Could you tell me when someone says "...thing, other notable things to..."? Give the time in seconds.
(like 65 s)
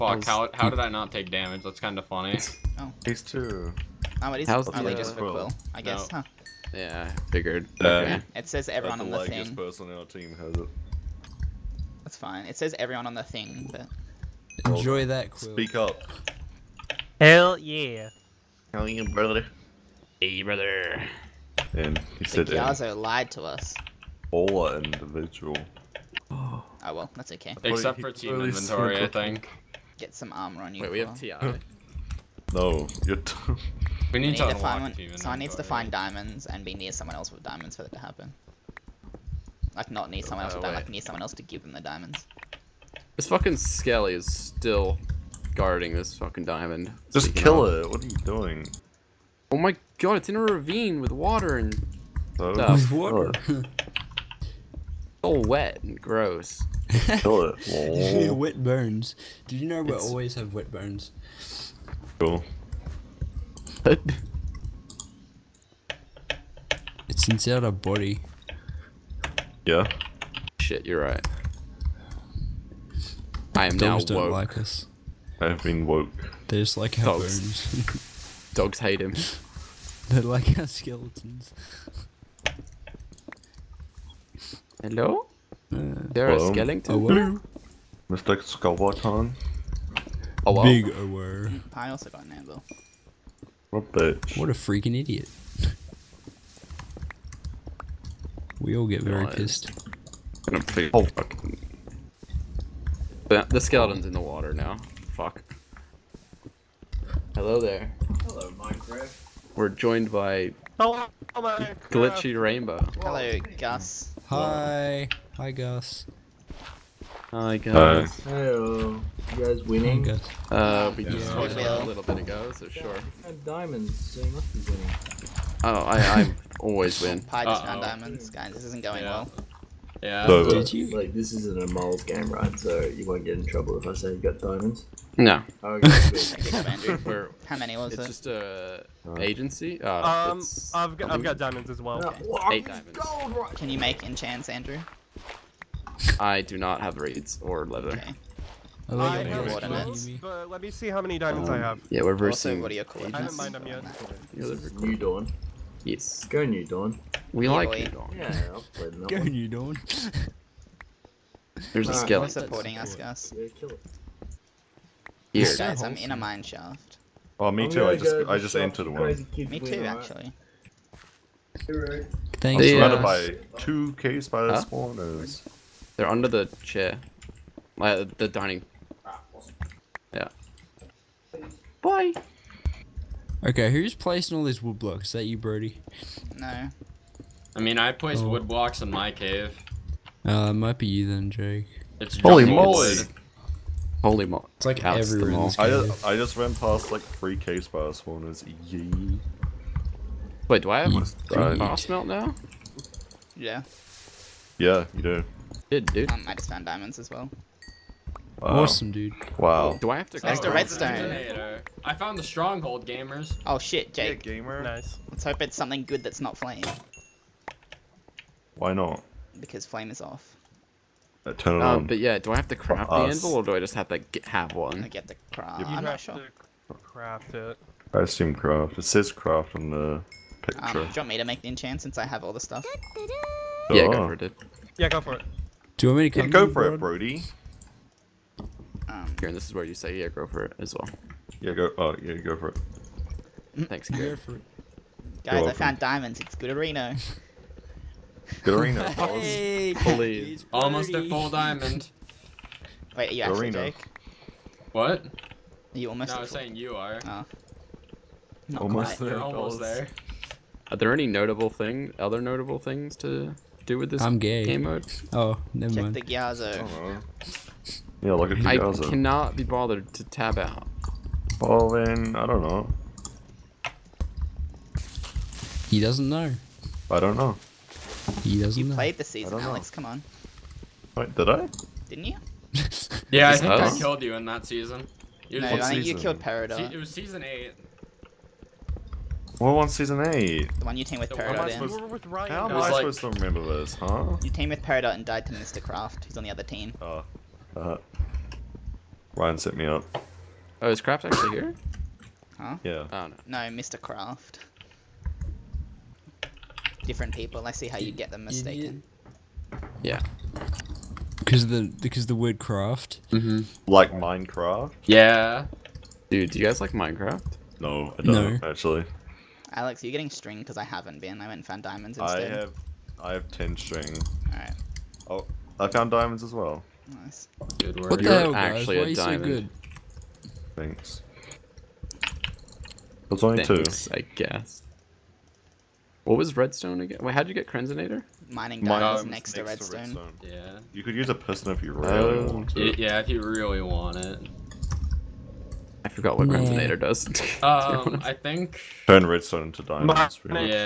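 261 s.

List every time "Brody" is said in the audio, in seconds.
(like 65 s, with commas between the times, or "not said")
185 s, 236 s.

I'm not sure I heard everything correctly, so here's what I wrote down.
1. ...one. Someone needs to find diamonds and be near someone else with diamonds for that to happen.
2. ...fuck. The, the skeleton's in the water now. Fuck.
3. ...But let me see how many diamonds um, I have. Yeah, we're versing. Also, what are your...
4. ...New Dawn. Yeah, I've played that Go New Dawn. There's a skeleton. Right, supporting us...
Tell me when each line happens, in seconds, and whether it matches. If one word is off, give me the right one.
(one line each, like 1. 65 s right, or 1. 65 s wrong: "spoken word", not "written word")
1. 34 s right
2. 101 s right
3. 150 s right
4. 157 s right.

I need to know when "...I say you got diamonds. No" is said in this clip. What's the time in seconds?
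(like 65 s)
133 s.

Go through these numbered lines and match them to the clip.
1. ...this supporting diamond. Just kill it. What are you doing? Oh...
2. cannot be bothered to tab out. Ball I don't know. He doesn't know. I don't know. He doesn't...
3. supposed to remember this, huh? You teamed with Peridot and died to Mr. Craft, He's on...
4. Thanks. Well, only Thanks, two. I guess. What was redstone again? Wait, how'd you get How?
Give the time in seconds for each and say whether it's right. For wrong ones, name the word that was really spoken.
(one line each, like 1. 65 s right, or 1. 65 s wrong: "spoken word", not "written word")
1. 45 s wrong: "fucking", not "supporting"
2. 268 s right
3. 292 s right
4. 330 s wrong: "Crenzonator", not "How".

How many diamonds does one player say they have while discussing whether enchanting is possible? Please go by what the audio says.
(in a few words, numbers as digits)
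8.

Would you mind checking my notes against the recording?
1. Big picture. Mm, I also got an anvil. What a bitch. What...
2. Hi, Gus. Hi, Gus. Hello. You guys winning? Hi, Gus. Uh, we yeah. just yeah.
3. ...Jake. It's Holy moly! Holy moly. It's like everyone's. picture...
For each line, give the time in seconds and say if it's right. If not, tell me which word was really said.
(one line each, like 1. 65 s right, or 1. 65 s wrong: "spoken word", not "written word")
1. 90 s wrong: "aware", not "picture"
2. 115 s right
3. 191 s wrong: "everywhere", not "picture".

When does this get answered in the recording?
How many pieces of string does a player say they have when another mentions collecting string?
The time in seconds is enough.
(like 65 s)
323 s.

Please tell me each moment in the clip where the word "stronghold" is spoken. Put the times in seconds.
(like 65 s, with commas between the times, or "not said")
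212 s.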